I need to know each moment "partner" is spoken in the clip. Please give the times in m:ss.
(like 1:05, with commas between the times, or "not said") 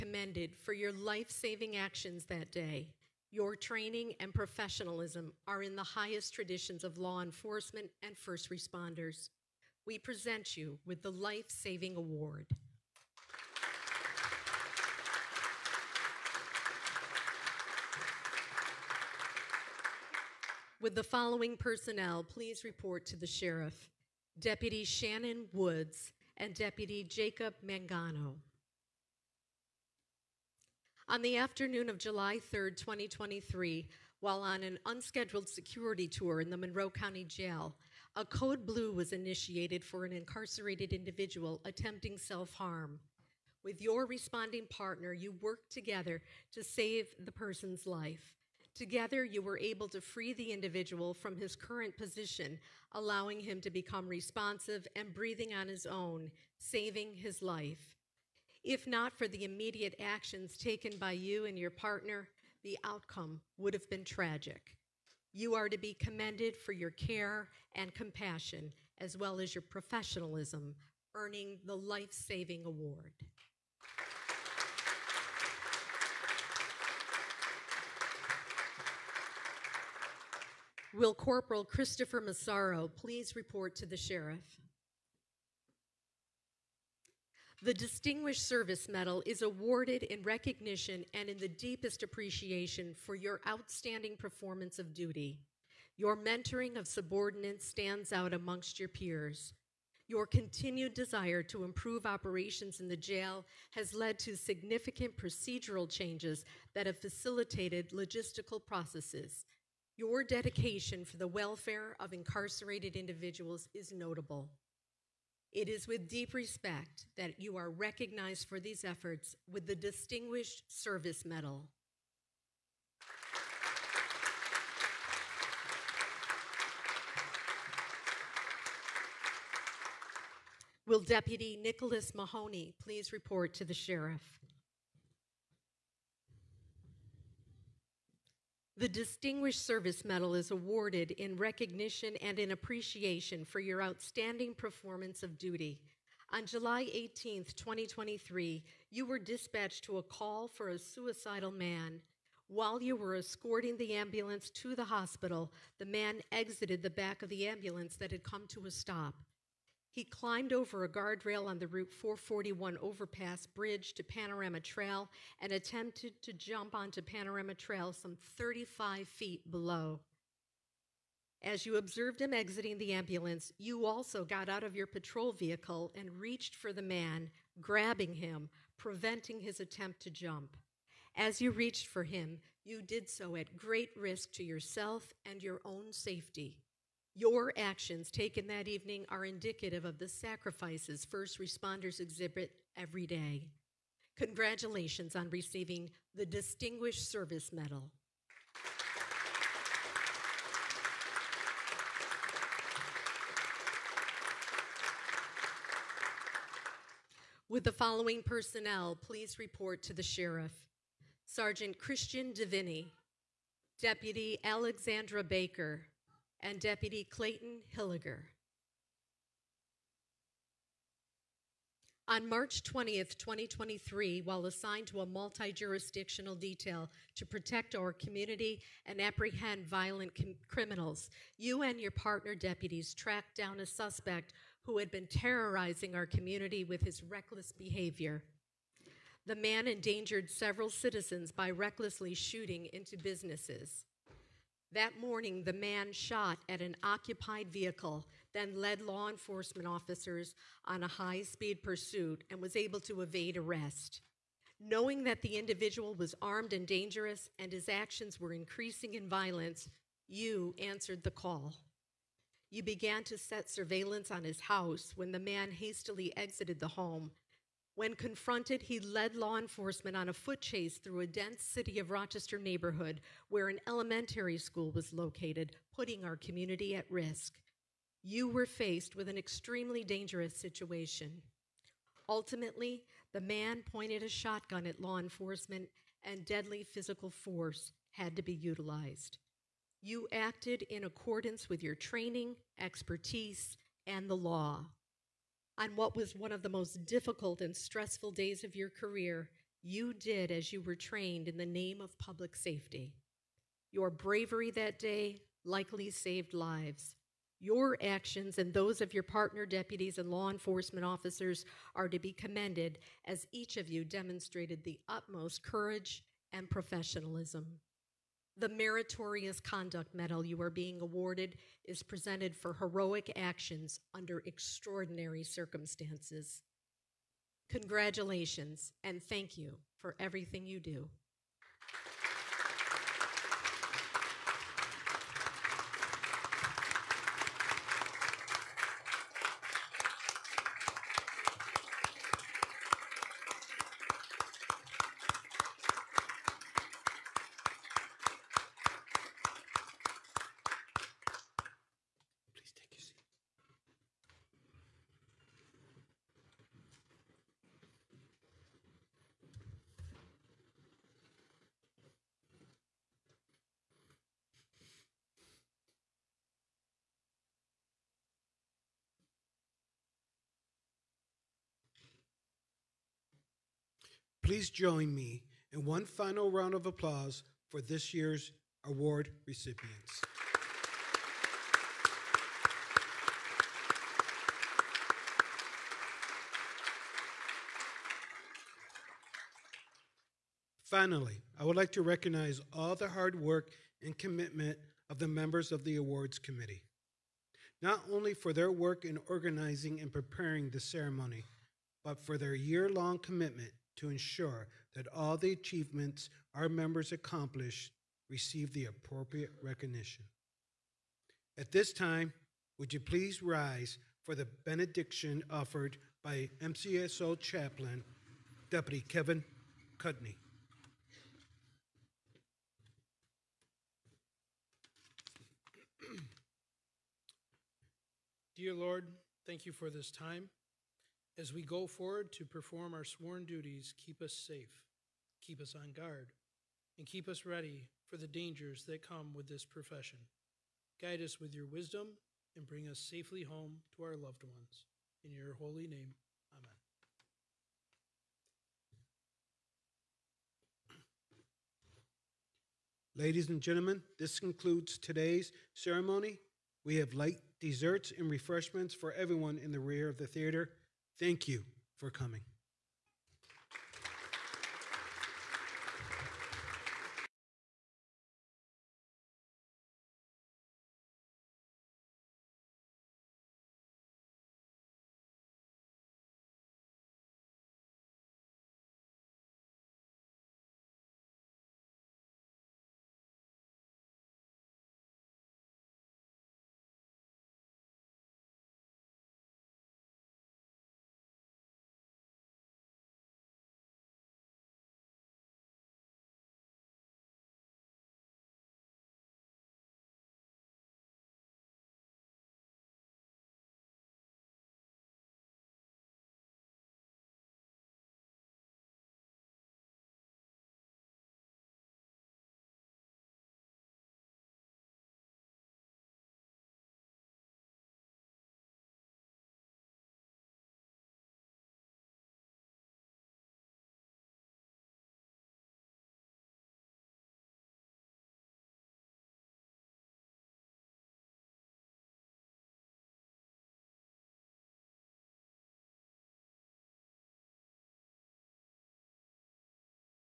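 0:44, 1:01, 3:51, 5:09.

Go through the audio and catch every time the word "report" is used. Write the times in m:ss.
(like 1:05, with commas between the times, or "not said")
0:22, 1:23, 2:13, 3:29.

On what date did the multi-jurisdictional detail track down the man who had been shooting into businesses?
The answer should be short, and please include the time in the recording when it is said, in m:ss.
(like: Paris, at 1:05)
March 20, 2023, at 3:42.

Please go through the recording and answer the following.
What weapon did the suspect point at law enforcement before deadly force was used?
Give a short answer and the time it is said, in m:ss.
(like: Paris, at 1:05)
Shotgun, at 4:44.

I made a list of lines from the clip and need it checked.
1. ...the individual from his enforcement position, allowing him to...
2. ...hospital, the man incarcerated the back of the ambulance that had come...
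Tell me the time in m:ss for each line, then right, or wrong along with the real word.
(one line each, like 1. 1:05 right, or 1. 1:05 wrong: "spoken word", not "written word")
1. 0:50 wrong: "current", not "enforcement"
2. 2:34 wrong: "exited", not "incarcerated".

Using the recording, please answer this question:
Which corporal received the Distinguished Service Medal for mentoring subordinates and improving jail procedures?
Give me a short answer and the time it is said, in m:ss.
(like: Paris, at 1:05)
Christopher Massaro, at 1:21.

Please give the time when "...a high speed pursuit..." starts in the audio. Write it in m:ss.
4:10.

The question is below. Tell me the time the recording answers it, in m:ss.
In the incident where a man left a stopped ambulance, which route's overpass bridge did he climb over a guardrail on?
2:41.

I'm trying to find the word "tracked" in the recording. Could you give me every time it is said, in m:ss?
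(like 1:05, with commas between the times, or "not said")
3:52.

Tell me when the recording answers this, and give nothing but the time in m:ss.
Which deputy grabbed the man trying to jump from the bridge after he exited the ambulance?
2:11.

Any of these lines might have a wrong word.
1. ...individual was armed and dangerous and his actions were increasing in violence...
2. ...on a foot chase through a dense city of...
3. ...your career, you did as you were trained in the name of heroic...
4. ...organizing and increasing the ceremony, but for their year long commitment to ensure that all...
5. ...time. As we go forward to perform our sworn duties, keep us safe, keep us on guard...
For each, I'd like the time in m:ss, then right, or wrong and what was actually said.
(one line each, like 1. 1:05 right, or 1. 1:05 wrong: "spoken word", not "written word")
1. 4:15 right
2. 4:29 right
3. 4:58 wrong: "public", not "heroic"
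4. 6:39 wrong: "preparing", not "increasing"
5. 7:09 right.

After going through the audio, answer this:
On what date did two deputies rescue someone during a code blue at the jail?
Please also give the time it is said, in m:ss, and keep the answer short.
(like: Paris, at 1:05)
July 3, 2023, at 0:31.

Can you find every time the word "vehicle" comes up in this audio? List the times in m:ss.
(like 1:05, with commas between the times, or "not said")
2:55, 4:07.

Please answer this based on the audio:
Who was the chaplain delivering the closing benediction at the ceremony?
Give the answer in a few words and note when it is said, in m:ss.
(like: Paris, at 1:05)
Kevin Cudney, at 6:58.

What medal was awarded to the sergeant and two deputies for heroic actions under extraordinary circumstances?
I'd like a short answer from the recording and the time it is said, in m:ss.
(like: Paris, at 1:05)
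Meritorious Conduct Medal, at 5:18.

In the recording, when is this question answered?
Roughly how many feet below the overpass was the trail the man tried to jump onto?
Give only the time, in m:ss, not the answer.
2:48.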